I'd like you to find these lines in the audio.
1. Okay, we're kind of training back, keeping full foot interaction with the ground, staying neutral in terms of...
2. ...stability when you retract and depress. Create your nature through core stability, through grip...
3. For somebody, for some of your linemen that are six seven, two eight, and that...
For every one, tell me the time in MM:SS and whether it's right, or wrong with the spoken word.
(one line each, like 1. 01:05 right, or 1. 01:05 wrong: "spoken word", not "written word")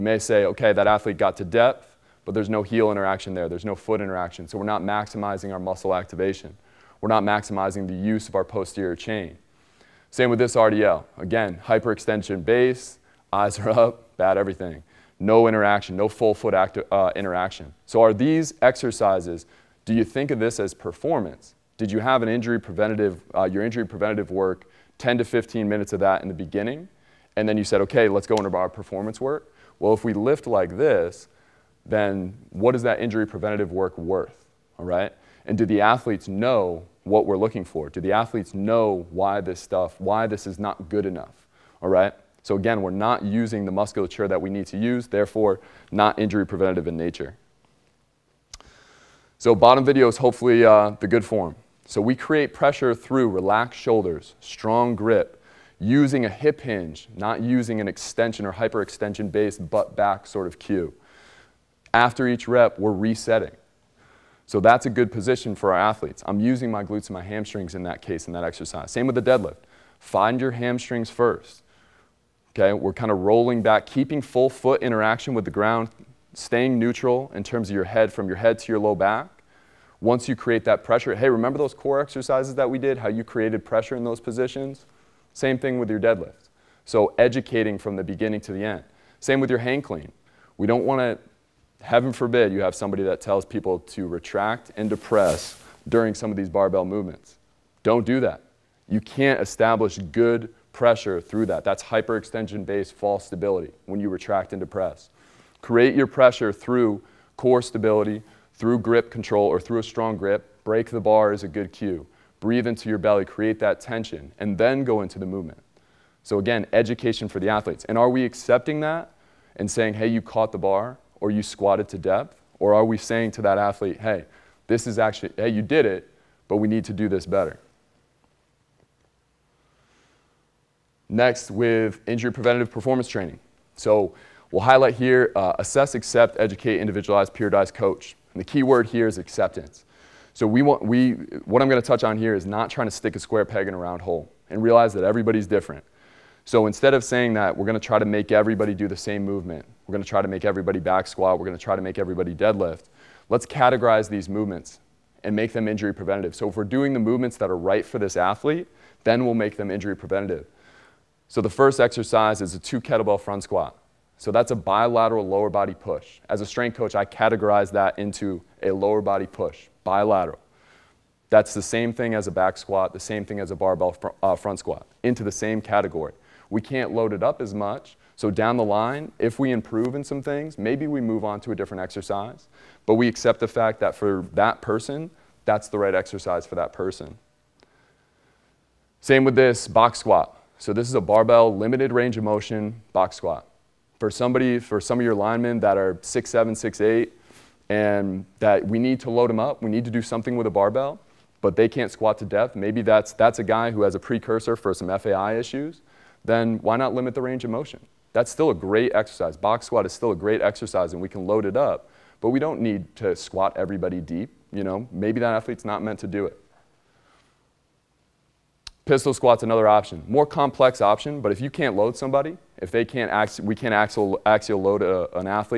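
1. 01:12 wrong: "rolling", not "training"
2. 01:43 wrong: "pressure", not "nature"
3. 03:13 wrong: "six", not "two".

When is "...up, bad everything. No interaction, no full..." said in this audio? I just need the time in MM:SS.
00:13.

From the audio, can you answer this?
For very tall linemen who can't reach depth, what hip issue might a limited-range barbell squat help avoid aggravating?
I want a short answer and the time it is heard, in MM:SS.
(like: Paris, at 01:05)
FAI, at 03:24.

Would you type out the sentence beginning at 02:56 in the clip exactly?
We can't load it up as much.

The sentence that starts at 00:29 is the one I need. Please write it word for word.
Well, if we lift like this, then what is that injury preventative work worth?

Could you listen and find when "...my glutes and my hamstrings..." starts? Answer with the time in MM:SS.
01:06.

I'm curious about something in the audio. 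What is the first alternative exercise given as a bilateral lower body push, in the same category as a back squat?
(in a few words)
Two kettlebell front squat.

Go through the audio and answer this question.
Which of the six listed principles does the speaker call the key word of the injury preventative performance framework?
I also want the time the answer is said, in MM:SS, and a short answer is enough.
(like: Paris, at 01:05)
Acceptance, at 02:19.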